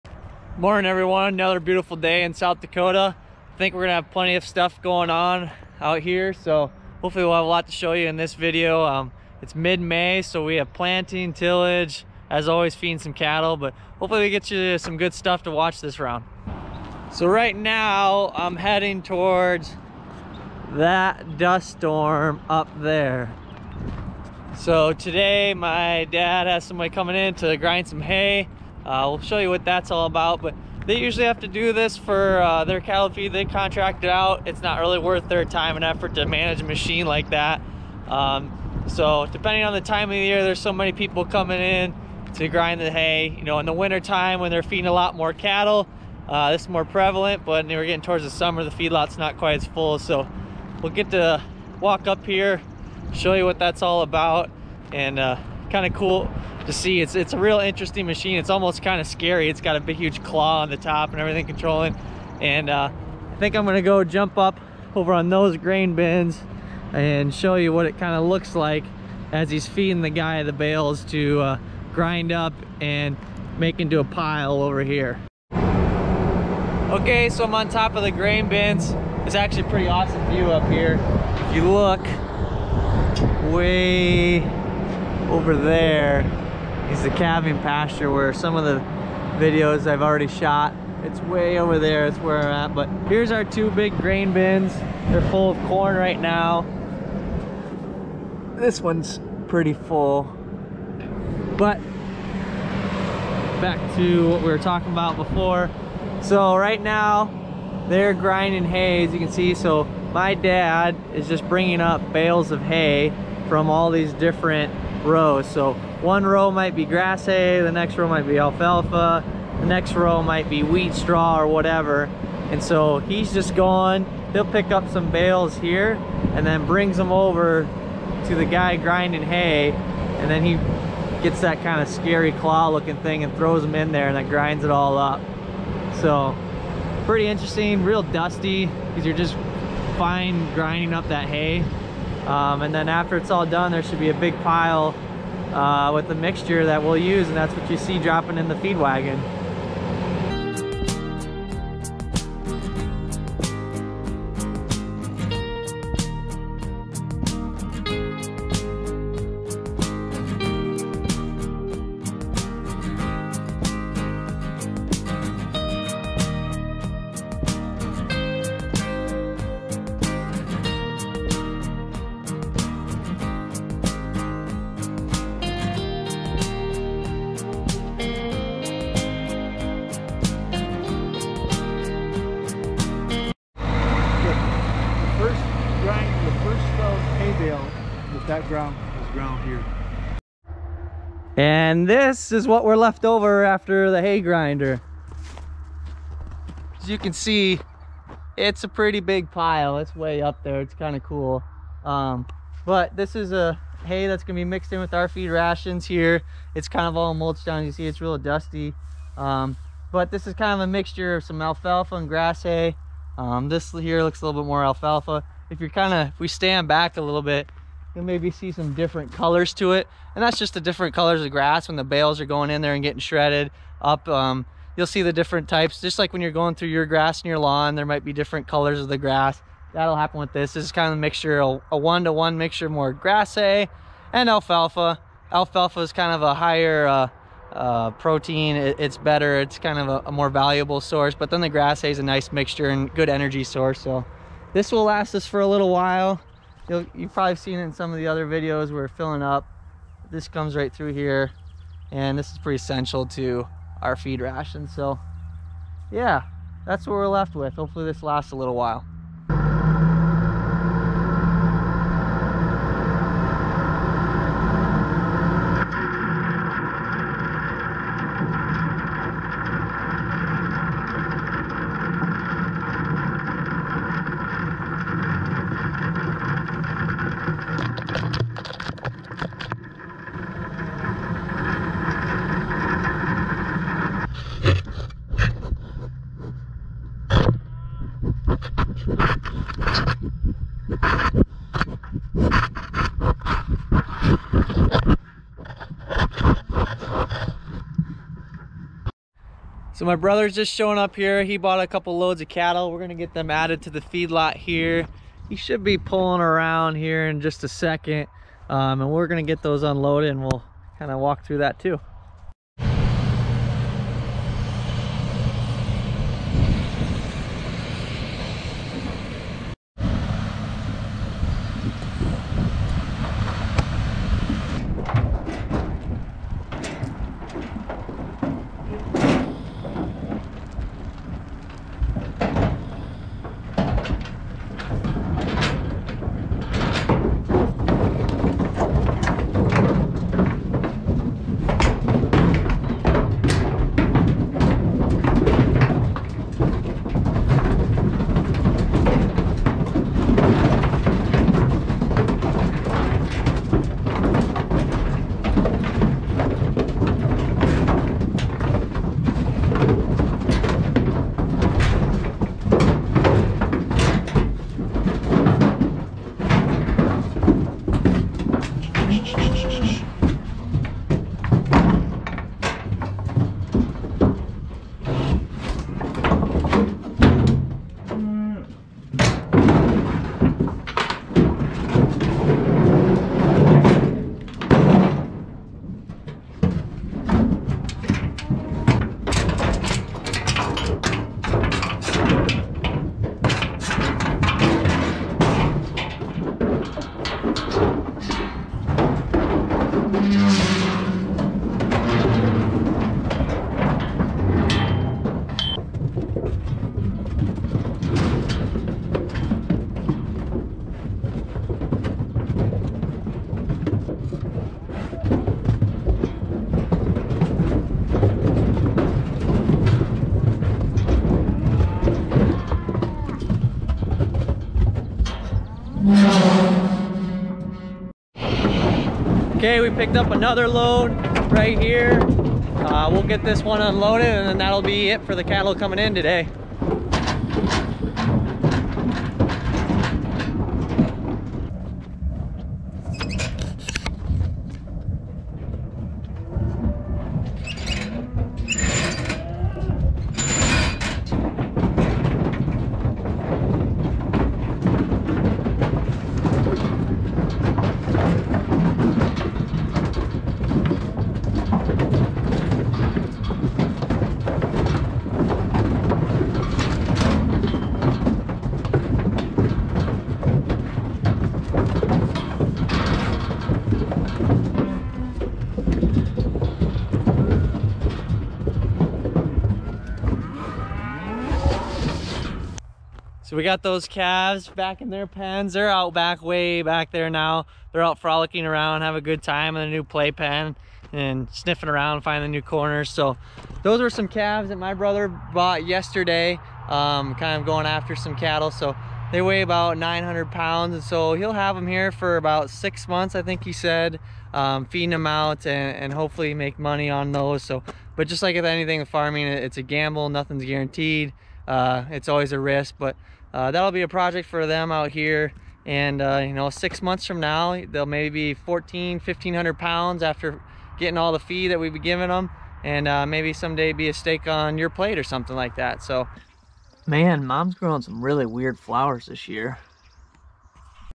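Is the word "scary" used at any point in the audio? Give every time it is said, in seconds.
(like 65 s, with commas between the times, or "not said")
59 s, 131 s.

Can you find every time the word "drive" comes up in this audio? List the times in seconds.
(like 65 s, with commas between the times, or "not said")
not said.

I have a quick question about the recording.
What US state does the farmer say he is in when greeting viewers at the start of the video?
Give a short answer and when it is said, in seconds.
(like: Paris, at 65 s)
South Dakota, at 2 s.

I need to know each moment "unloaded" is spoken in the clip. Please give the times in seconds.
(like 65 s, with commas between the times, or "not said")
309 s, 433 s.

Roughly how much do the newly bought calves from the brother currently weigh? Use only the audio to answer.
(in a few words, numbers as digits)
900 pounds.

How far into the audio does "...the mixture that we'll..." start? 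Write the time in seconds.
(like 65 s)
146 s.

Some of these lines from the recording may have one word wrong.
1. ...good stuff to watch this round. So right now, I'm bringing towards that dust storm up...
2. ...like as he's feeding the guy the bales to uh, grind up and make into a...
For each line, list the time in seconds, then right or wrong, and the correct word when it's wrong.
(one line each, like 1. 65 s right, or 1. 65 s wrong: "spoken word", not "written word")
1. 14 s wrong: "heading", not "bringing"
2. 68 s right.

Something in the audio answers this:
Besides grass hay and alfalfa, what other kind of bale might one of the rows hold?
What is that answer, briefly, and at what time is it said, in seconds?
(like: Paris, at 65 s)
wheat straw, at 120 s.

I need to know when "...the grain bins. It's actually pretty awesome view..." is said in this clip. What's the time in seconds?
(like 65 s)
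78 s.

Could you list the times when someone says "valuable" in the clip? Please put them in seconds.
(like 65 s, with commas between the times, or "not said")
240 s.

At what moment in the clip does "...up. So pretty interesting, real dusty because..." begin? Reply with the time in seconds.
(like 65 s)
134 s.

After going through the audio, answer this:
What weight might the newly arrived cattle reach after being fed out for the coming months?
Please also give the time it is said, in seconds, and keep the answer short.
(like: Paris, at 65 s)
1500 pounds, at 518 s.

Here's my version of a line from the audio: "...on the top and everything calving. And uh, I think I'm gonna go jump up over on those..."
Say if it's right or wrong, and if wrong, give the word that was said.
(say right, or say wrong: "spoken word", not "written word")
wrong: "controlling", not "calving".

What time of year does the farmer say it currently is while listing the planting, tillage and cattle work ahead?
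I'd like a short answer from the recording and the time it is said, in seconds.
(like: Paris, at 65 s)
mid-May, at 9 s.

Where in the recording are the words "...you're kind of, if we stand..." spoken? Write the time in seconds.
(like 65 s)
215 s.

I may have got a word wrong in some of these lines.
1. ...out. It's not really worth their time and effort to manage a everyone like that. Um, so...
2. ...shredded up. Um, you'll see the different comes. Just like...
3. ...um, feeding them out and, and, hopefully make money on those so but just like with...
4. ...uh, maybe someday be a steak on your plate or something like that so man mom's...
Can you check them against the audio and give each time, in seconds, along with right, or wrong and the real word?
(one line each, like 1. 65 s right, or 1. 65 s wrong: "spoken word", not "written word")
1. 34 s wrong: "machine", not "everyone"
2. 222 s wrong: "types", not "comes"
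3. 504 s right
4. 522 s right.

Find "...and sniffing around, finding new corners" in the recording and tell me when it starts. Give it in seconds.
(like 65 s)
490 s.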